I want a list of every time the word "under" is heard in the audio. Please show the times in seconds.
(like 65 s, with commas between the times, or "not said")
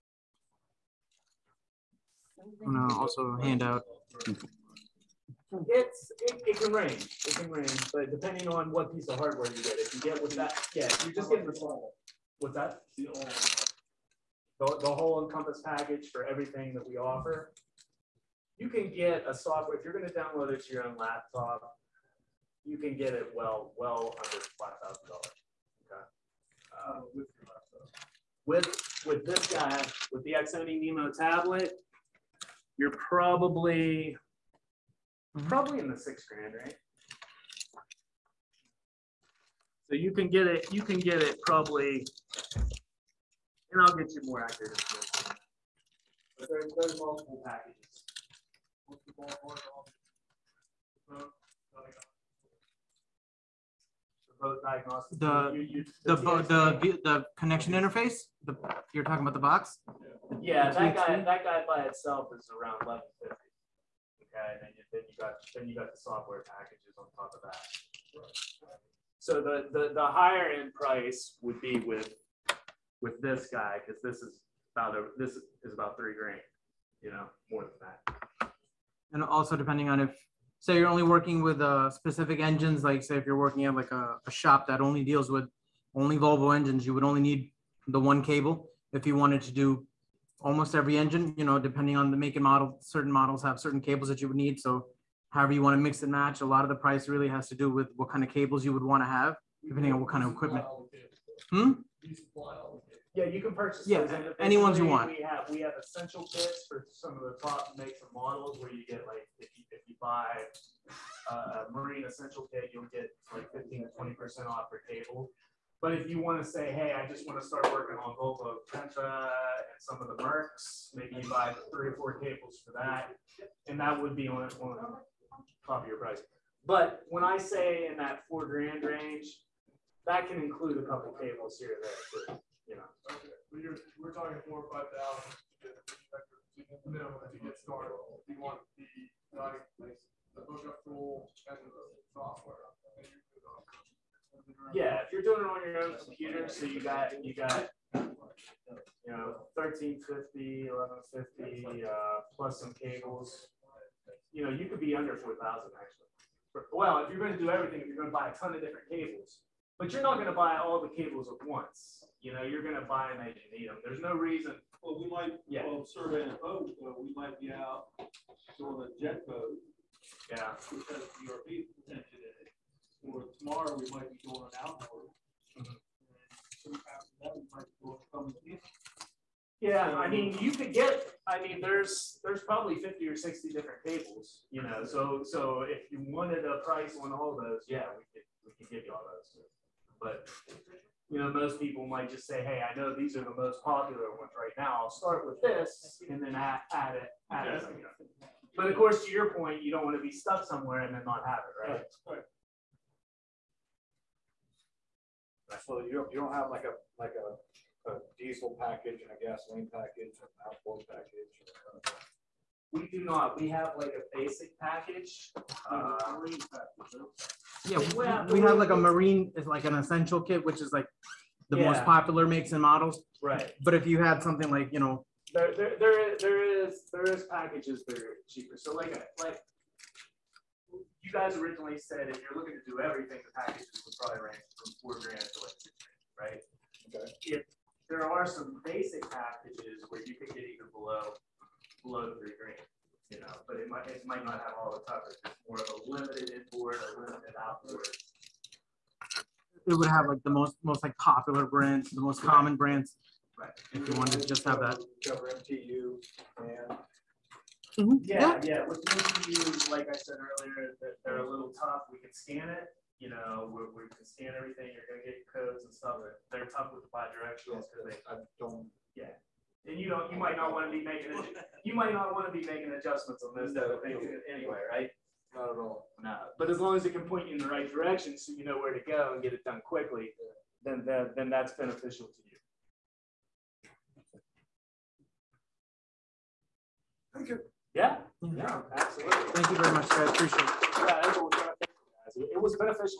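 24 s, 154 s.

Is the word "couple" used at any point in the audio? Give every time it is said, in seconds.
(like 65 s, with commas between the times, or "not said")
130 s.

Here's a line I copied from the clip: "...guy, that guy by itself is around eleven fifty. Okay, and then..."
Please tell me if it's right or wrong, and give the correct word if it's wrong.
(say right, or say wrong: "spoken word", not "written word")
right.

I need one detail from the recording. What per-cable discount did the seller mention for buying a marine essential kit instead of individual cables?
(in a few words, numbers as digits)
15 to 20 percent.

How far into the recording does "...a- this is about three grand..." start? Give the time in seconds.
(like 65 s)
74 s.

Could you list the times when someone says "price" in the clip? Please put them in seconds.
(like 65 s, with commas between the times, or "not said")
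70 s, 96 s, 125 s, 186 s.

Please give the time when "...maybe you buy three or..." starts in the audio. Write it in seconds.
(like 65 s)
120 s.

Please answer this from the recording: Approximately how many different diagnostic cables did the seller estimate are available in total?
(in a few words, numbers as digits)
50 or 60.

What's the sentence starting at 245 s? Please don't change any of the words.
It's more of a limited inboard or limited outboard.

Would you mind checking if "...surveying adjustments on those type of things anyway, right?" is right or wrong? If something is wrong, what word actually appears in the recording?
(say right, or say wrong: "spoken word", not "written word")
wrong: "making", not "surveying".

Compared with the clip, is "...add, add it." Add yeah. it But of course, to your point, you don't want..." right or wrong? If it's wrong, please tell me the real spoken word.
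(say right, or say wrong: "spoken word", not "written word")
right.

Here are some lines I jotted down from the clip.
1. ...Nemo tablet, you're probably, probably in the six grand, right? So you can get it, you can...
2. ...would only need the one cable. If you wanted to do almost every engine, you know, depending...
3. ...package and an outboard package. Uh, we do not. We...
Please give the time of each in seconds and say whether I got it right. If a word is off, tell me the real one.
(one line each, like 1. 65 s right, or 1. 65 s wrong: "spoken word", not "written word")
1. 30 s right
2. 86 s right
3. 209 s right.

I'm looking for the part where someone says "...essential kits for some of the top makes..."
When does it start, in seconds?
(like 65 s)
105 s.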